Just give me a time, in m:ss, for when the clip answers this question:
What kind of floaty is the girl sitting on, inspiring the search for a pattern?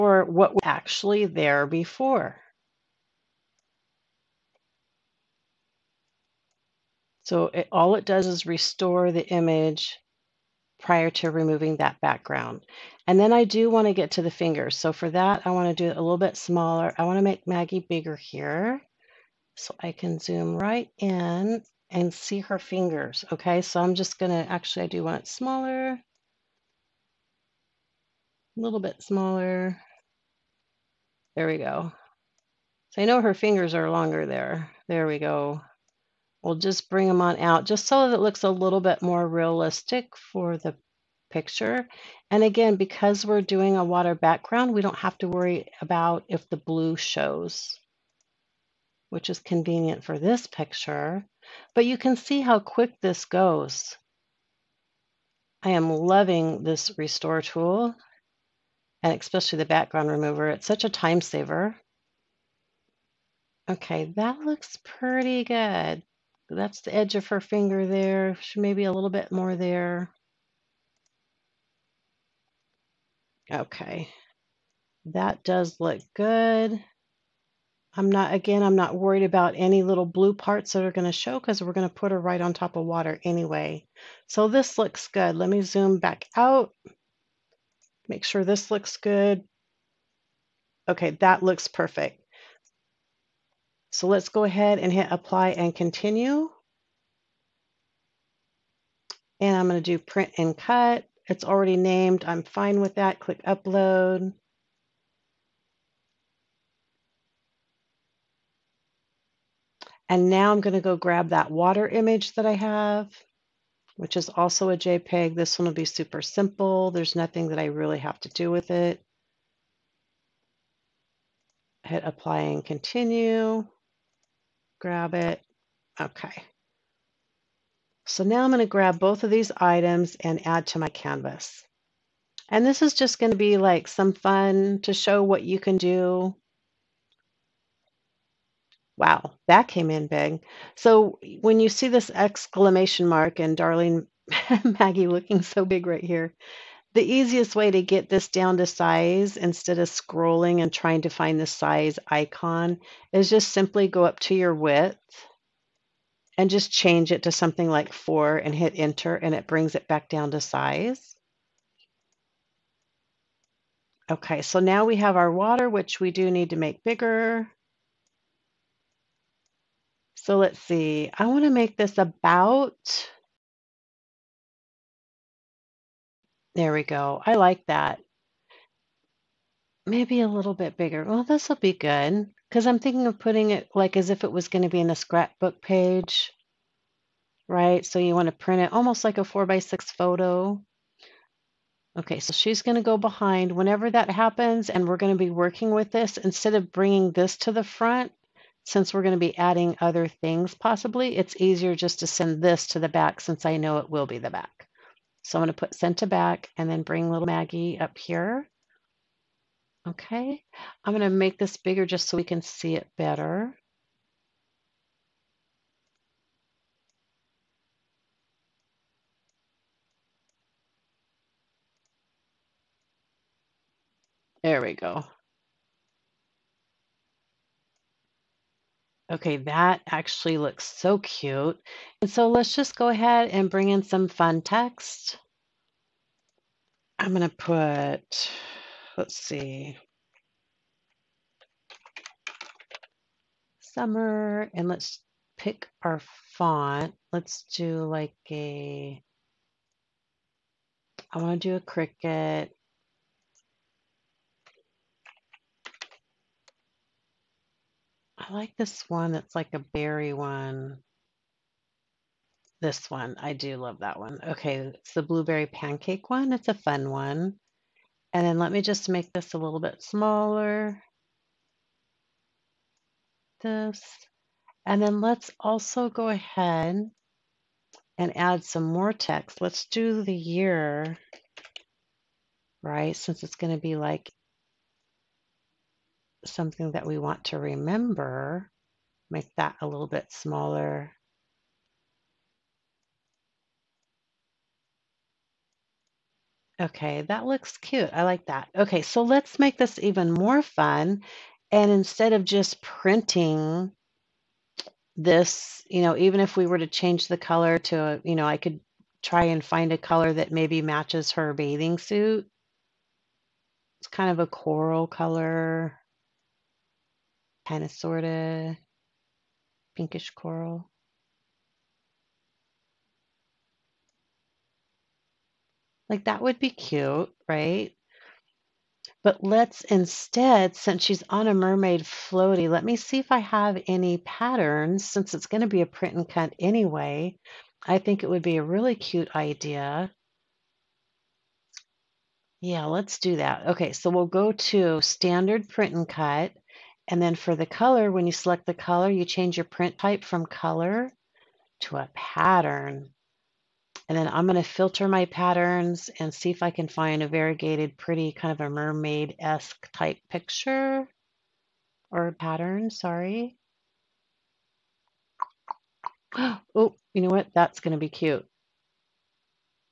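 5:31.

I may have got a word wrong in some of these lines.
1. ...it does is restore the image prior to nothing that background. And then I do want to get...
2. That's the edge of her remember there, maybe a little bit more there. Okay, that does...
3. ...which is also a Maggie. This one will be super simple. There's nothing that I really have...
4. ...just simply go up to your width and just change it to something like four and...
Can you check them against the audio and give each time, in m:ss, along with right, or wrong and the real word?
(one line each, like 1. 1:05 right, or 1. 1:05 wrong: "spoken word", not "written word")
1. 0:07 wrong: "removing", not "nothing"
2. 1:06 wrong: "finger", not "remember"
3. 1:53 wrong: "JPEG", not "Maggie"
4. 2:33 right.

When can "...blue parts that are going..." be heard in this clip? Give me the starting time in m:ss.
1:20.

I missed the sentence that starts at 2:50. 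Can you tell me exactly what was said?
So let's see, I wanna make this about There we go.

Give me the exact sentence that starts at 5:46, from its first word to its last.
And then for the color, when you select the color, you change your print type from color to a pattern.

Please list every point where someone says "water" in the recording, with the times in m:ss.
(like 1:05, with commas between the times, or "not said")
0:43, 1:22, 1:51, 2:45.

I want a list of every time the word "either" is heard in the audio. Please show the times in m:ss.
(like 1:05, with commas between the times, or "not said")
not said.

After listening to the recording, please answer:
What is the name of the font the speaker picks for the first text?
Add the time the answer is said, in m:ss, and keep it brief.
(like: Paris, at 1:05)
Blueberry pancake, at 4:25.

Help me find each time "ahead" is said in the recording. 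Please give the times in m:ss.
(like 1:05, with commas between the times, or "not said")
1:34, 3:52, 4:36.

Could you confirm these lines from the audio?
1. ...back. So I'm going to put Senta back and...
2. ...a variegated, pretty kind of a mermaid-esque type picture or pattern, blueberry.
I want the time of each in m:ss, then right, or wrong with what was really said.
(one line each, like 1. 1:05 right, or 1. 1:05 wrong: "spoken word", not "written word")
1. 3:24 right
2. 5:57 wrong: "sorry", not "blueberry".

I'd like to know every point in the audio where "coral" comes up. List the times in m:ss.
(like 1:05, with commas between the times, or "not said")
5:14, 5:20.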